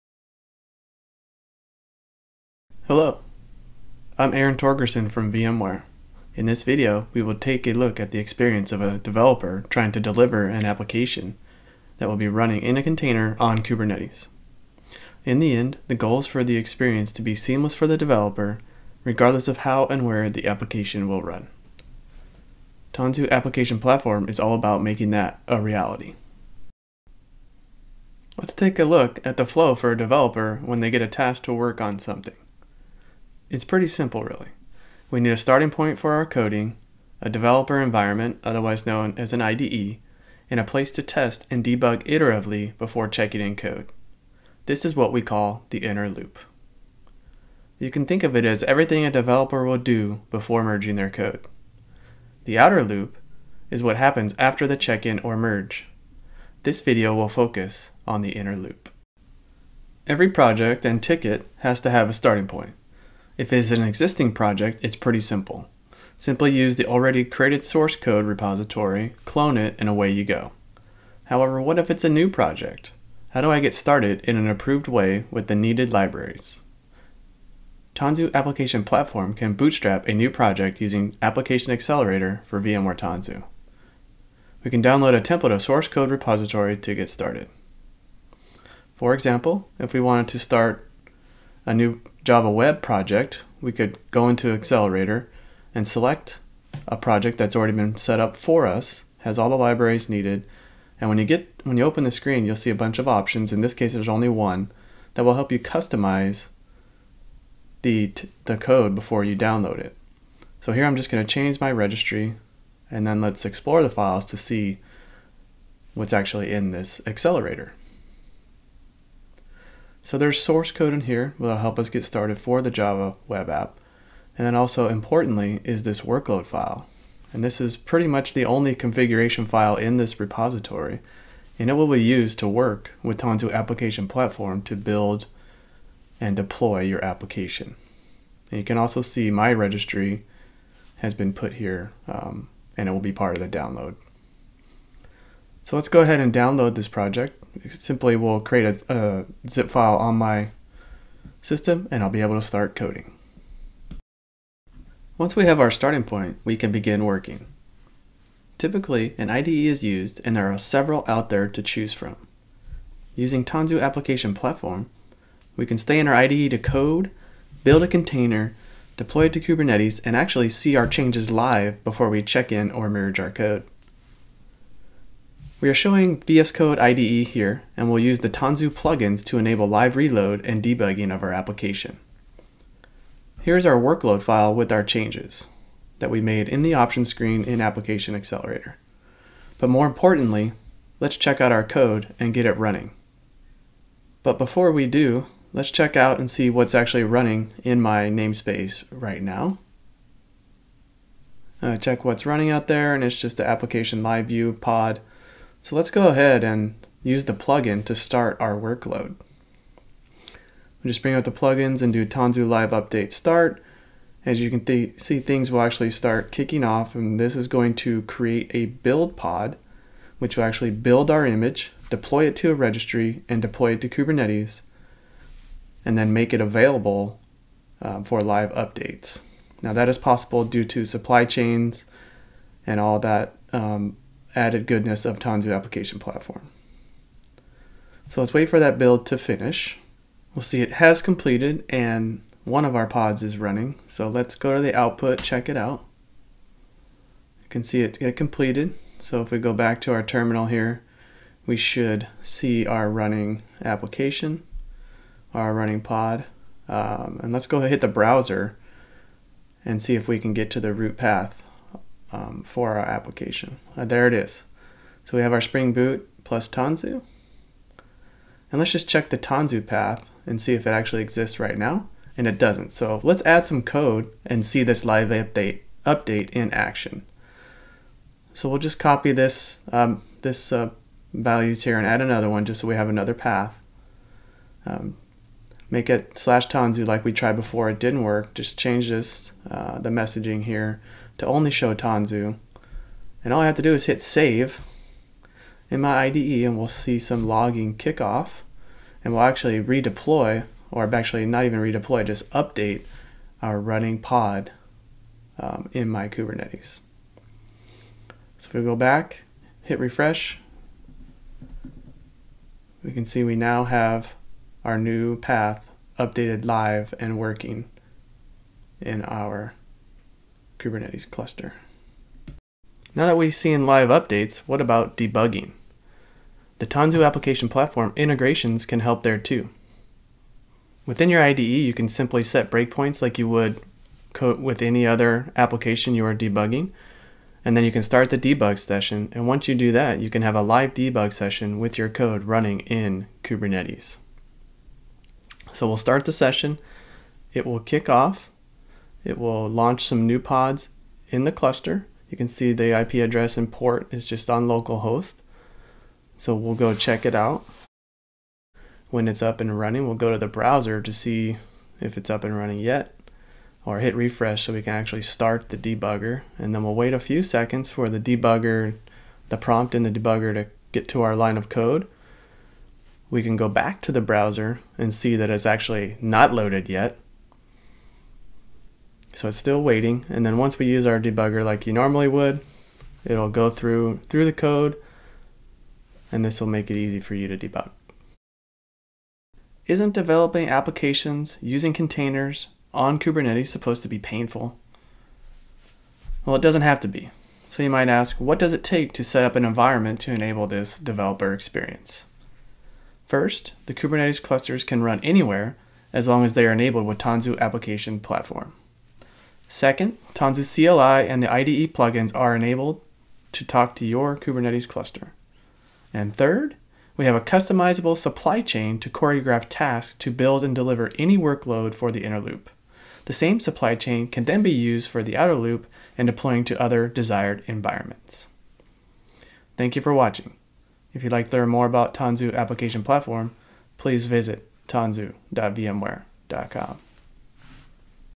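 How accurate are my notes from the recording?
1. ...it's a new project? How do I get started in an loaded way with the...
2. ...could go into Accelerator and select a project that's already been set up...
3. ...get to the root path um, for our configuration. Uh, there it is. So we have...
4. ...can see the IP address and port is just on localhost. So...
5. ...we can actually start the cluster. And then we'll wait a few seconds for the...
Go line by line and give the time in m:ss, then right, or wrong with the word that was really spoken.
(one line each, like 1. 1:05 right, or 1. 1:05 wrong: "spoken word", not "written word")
1. 1:11 wrong: "approved", not "loaded"
2. 1:33 right
3. 4:20 wrong: "application", not "configuration"
4. 5:52 right
5. 6:04 wrong: "debugger", not "cluster".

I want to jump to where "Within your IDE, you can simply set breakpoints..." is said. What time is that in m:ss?
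5:30.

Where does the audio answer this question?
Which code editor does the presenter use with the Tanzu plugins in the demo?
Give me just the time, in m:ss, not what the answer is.
2:56.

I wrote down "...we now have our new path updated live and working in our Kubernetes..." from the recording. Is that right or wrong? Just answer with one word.
right.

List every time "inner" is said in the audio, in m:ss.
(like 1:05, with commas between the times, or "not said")
0:45, 0:58, 7:02.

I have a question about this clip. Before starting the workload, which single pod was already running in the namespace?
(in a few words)
application live view.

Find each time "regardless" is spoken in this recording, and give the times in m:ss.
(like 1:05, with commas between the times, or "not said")
0:19.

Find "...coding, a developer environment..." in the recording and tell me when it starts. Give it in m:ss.
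0:36.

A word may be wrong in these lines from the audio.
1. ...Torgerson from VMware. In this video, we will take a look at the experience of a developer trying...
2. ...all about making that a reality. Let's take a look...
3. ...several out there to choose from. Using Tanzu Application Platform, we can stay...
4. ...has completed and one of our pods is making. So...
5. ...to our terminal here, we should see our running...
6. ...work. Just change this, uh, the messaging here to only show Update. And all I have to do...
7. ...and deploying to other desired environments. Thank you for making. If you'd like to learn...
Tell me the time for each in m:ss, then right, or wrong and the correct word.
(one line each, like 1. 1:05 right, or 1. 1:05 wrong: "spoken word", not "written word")
1. 0:04 right
2. 0:24 right
3. 2:40 right
4. 4:00 wrong: "running", not "making"
5. 4:09 right
6. 4:48 wrong: "Tanzu", not "Update"
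7. 7:05 wrong: "watching", not "making".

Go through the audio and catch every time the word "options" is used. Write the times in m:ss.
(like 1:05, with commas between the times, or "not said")
1:43, 3:06.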